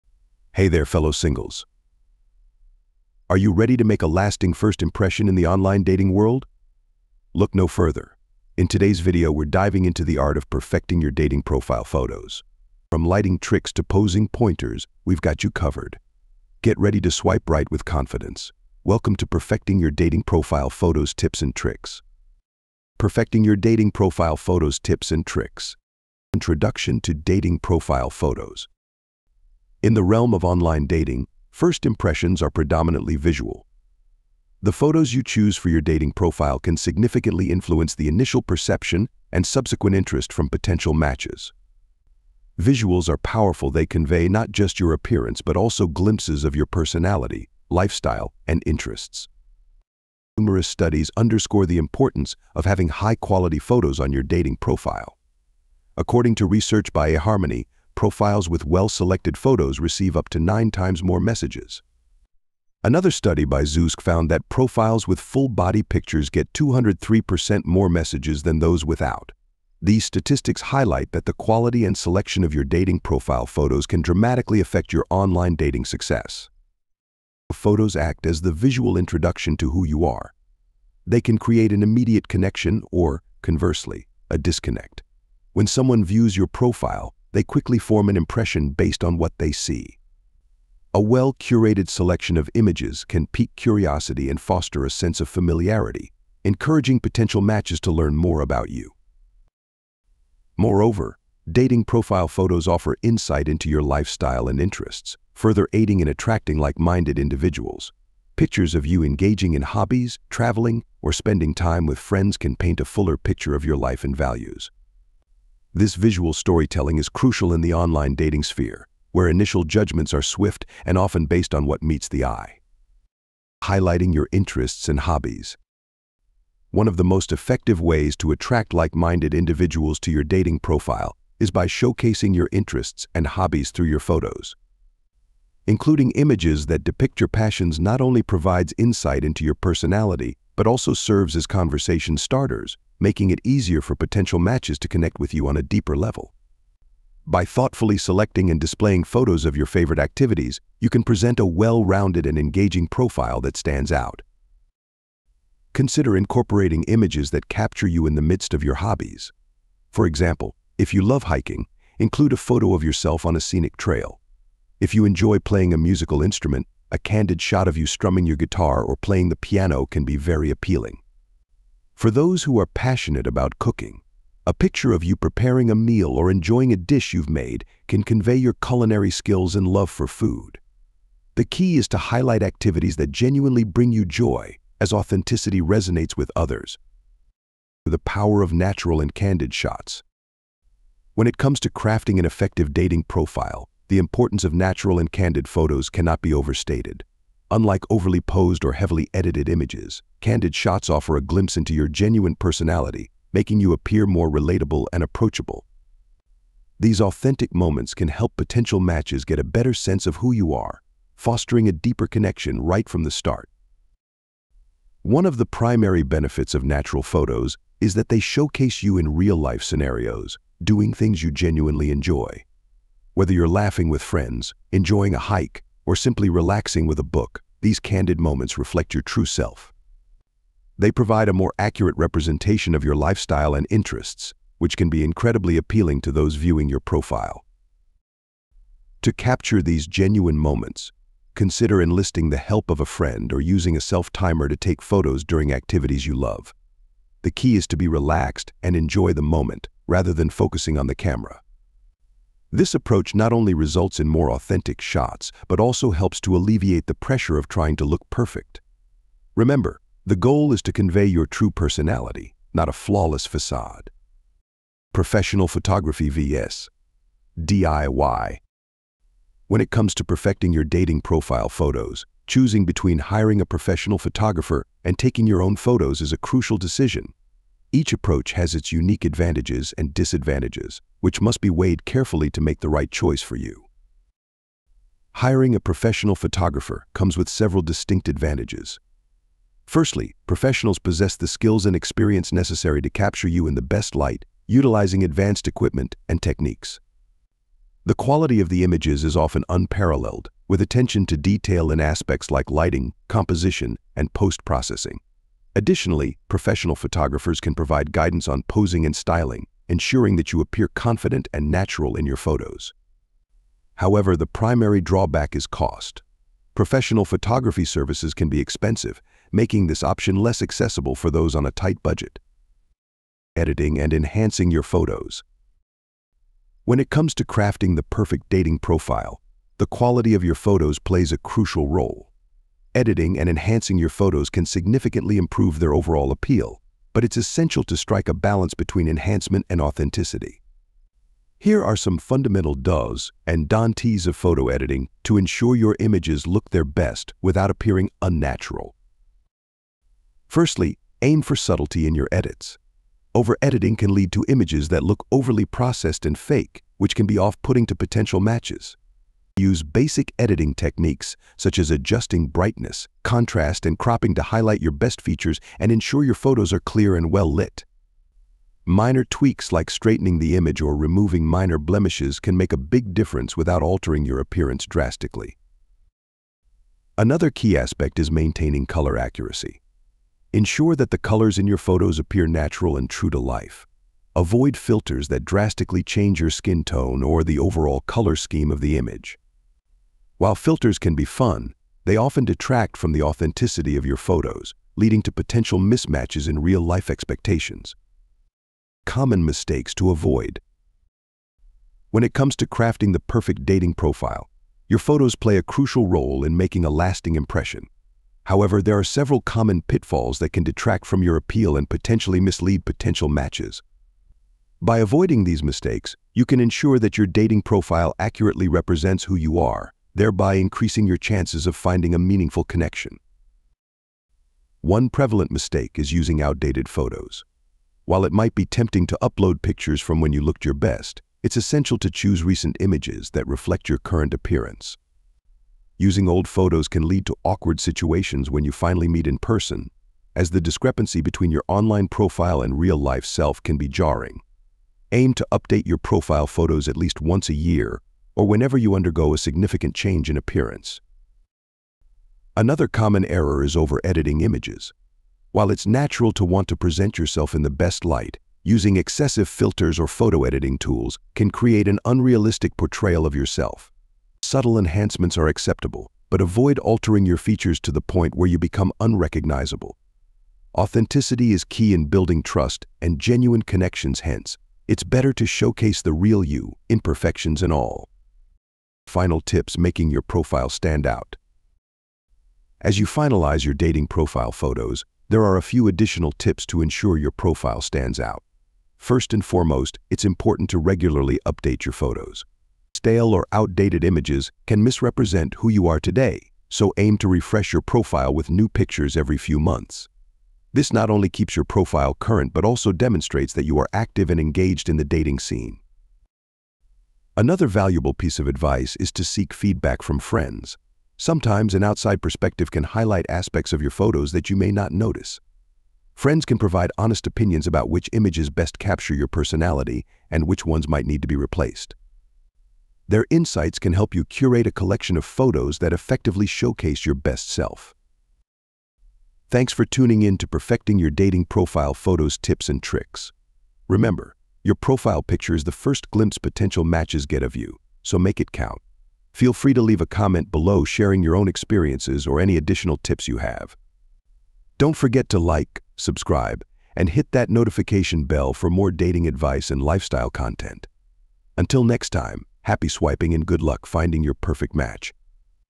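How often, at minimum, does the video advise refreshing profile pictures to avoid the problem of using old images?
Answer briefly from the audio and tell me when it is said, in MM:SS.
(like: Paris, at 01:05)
once a year, at 07:27.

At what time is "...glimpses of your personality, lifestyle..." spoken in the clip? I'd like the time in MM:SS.
00:45.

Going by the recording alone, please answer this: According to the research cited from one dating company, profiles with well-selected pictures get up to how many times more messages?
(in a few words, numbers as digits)
9.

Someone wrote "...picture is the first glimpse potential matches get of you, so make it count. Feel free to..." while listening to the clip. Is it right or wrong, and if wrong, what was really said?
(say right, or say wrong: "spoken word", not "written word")
right.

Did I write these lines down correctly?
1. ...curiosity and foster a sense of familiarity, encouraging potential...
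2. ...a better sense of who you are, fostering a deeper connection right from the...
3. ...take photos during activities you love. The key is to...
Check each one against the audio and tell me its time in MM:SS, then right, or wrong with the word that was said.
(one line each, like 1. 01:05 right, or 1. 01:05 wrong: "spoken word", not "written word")
1. 01:33 right
2. 03:29 right
3. 04:04 right.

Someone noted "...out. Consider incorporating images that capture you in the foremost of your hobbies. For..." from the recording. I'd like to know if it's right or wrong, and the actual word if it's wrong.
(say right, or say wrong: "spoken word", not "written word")
wrong: "midst", not "foremost".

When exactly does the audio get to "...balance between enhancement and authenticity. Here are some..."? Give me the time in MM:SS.
05:38.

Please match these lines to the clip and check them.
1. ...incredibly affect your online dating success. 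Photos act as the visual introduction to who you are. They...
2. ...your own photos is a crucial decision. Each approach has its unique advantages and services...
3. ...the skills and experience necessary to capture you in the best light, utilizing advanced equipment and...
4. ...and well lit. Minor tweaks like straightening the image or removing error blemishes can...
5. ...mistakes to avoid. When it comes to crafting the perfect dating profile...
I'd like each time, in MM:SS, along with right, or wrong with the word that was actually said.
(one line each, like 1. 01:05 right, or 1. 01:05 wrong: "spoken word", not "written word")
1. 01:14 wrong: "dramatically", not "incredibly"
2. 04:35 wrong: "disadvantages", not "services"
3. 04:51 right
4. 06:06 wrong: "minor", not "error"
5. 06:39 right.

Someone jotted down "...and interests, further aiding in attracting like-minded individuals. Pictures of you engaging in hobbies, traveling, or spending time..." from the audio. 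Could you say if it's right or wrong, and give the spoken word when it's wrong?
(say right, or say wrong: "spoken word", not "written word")
right.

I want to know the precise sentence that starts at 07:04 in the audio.
One prevalent mistake is using outdated photos.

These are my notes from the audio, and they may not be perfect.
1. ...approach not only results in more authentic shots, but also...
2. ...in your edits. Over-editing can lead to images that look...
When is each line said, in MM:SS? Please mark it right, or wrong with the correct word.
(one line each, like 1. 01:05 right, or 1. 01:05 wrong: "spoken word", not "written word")
1. 04:12 right
2. 05:51 right.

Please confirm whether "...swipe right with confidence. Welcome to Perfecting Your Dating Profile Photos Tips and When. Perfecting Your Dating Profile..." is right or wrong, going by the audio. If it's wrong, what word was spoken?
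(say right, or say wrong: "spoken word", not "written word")
wrong: "Tricks", not "When".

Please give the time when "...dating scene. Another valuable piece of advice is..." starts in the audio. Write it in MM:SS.
08:24.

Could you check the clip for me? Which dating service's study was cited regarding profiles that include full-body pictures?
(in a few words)
Zoosk.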